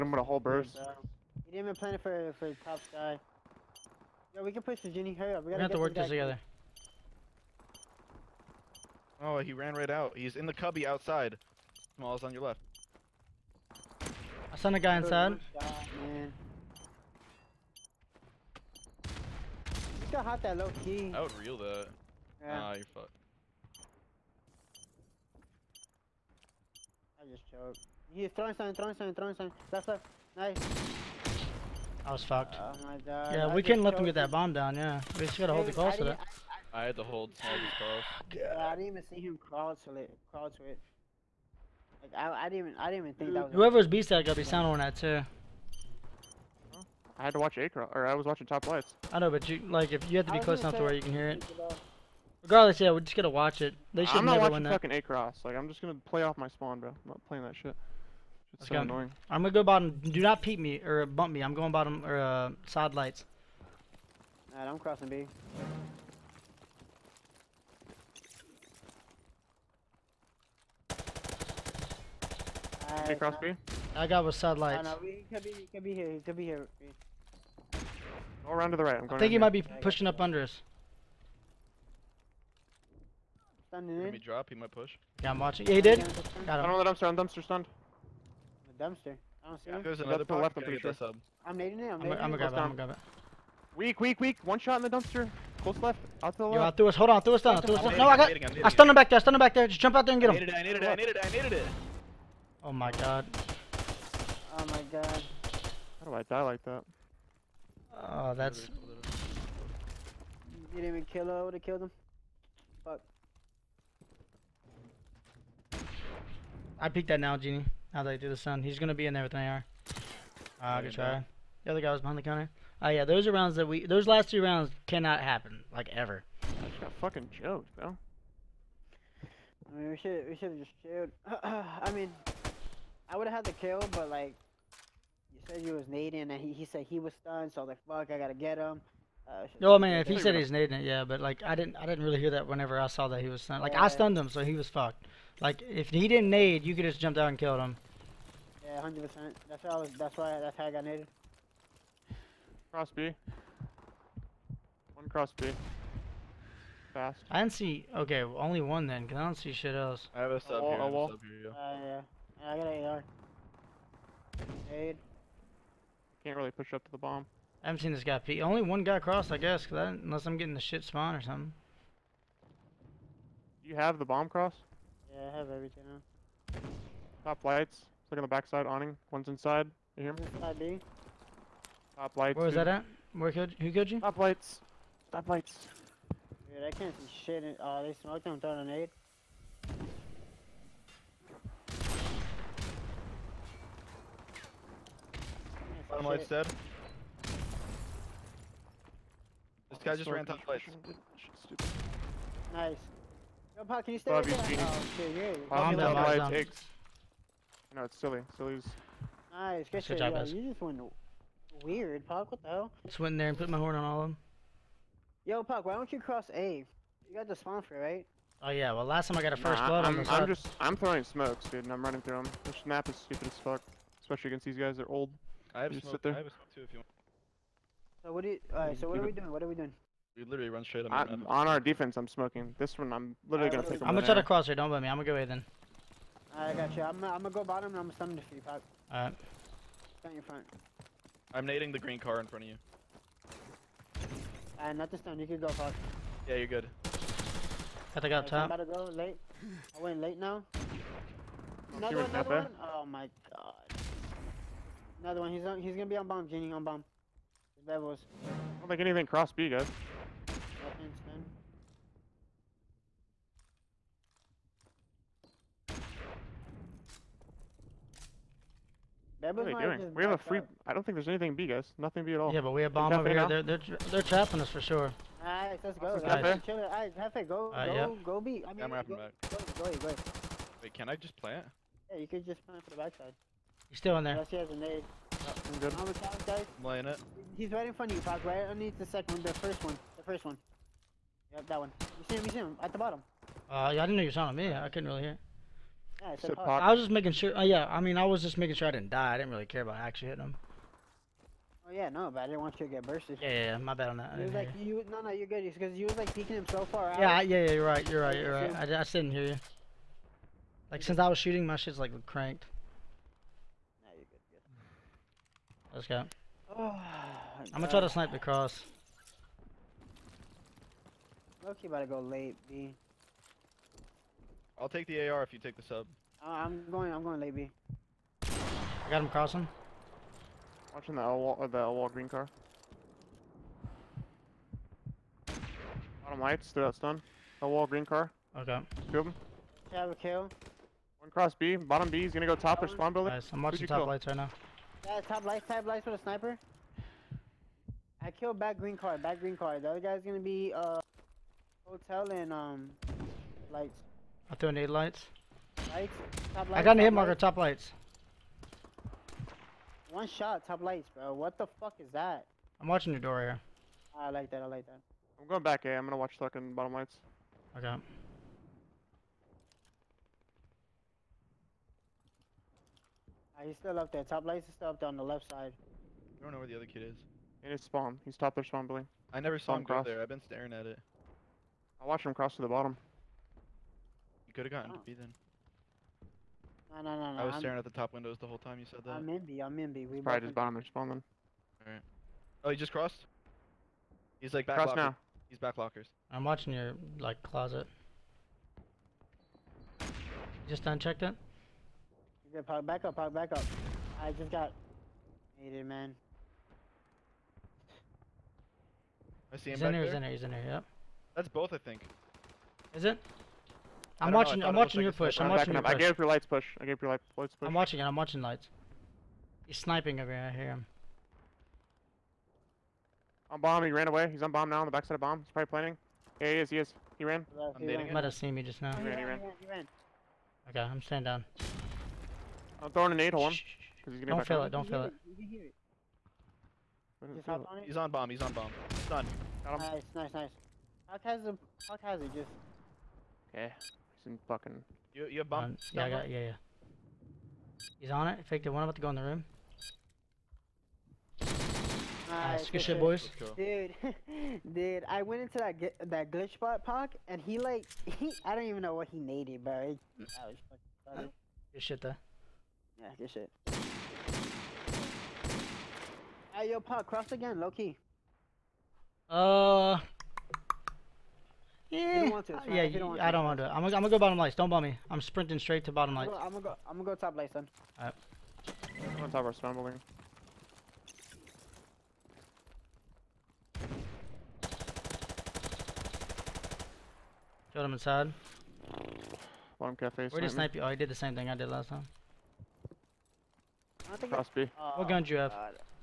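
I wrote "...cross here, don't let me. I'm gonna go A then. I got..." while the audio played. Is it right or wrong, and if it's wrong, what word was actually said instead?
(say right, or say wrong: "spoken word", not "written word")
right.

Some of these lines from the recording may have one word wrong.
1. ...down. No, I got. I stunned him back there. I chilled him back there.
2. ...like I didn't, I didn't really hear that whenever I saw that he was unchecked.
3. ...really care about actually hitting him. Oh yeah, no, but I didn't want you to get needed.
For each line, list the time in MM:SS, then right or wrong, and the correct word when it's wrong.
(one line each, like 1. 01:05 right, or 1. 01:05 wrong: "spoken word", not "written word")
1. 01:37 wrong: "stunned", not "chilled"
2. 02:21 wrong: "stunned", not "unchecked"
3. 04:59 wrong: "bursted", not "needed".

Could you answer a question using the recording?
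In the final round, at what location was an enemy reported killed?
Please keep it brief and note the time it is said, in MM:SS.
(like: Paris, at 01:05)
Bottom cafe, at 08:09.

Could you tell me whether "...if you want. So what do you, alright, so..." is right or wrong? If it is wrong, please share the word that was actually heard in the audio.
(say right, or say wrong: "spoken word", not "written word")
right.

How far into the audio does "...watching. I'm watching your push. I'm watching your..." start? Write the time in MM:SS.
06:54.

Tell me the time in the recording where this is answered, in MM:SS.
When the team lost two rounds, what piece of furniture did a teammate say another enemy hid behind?
02:01.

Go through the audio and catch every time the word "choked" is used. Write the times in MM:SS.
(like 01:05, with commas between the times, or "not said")
00:27, 02:07.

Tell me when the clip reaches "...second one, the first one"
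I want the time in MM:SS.
04:48.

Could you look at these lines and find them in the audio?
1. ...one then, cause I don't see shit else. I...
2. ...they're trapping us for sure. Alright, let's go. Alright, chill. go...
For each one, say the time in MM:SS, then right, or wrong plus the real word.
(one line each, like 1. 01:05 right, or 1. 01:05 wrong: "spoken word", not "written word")
1. 02:38 right
2. 04:33 right.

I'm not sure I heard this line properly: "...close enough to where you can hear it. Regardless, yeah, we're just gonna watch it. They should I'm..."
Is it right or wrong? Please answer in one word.
right.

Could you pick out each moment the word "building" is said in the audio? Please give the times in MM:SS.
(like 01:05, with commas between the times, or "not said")
05:42, 06:18.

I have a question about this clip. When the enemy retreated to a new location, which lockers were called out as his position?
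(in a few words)
Back lockers.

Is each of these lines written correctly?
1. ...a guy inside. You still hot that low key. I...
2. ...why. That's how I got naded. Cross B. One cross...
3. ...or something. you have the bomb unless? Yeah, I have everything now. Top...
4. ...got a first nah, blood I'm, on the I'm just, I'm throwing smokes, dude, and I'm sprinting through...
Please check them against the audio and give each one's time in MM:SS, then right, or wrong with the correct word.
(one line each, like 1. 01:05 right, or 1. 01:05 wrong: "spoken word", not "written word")
1. 00:14 right
2. 02:30 right
3. 02:51 wrong: "cross", not "unless"
4. 03:39 wrong: "running", not "sprinting".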